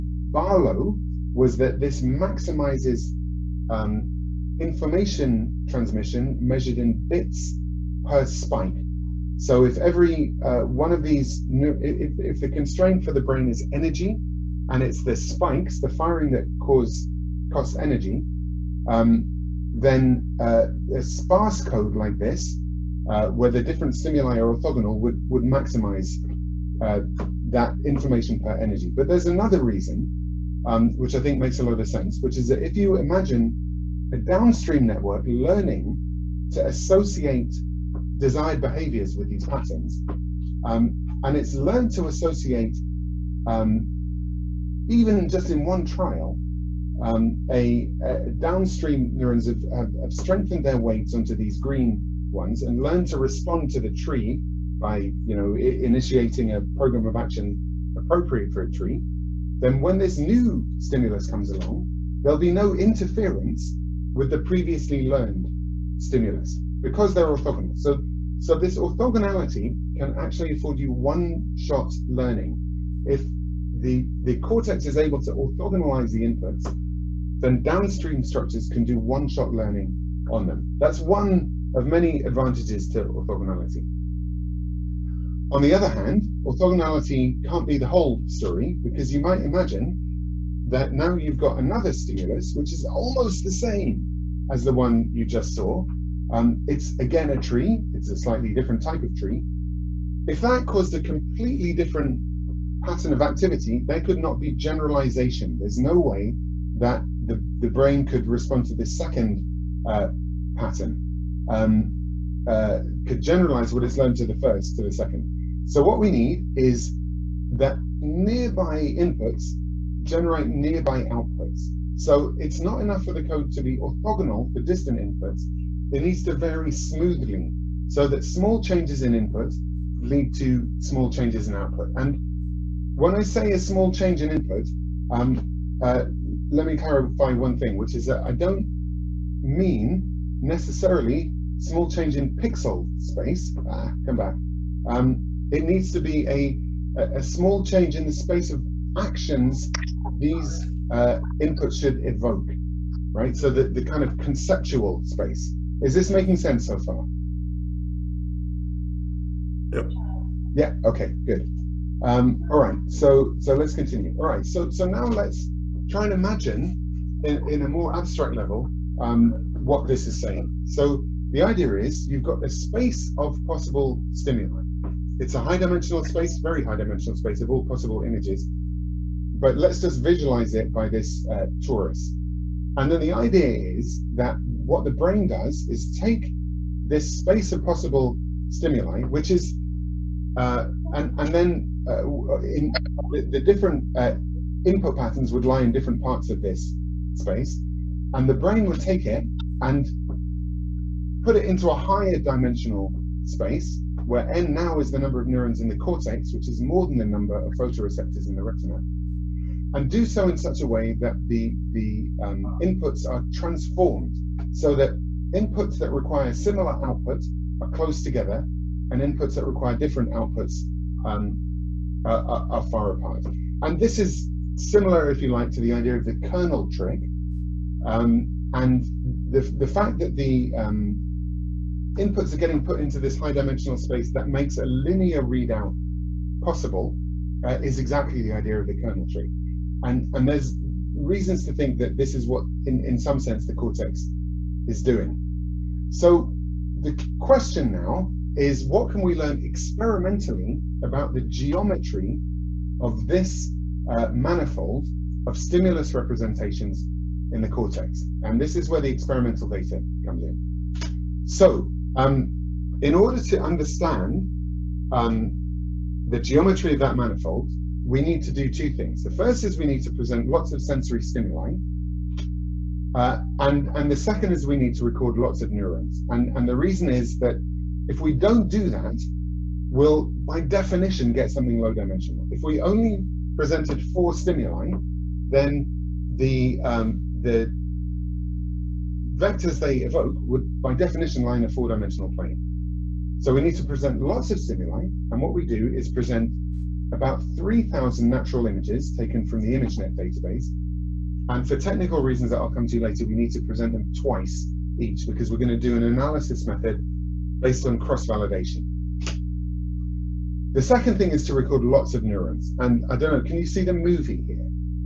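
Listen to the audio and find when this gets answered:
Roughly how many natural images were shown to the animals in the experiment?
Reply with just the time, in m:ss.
4:57.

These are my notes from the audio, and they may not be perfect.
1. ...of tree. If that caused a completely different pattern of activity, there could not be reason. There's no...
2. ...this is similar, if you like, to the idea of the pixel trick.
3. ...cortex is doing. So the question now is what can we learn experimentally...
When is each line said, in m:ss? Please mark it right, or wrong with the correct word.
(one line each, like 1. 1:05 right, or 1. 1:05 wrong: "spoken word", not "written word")
1. 1:39 wrong: "generalization", not "reason"
2. 3:43 wrong: "kernel", not "pixel"
3. 4:03 right.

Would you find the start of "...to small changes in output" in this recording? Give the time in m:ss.
2:10.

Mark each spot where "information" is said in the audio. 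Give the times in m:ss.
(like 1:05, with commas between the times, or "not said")
0:04, 0:27.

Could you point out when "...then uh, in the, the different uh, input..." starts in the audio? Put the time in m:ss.
3:11.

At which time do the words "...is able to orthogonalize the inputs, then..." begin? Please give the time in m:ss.
1:14.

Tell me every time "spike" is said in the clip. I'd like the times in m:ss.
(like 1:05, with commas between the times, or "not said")
0:08, 0:15.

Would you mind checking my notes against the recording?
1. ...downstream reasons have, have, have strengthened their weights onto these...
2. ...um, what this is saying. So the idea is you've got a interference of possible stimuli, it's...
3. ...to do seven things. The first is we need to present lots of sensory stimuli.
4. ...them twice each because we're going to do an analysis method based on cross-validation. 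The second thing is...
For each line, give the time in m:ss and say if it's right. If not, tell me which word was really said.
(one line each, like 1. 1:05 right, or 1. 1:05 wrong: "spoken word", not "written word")
1. 0:48 wrong: "neurons", not "reasons"
2. 2:48 wrong: "space", not "interference"
3. 4:28 wrong: "two", not "seven"
4. 5:03 right.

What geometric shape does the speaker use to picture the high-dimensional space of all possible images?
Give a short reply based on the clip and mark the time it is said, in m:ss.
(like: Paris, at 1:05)
Torus, at 3:01.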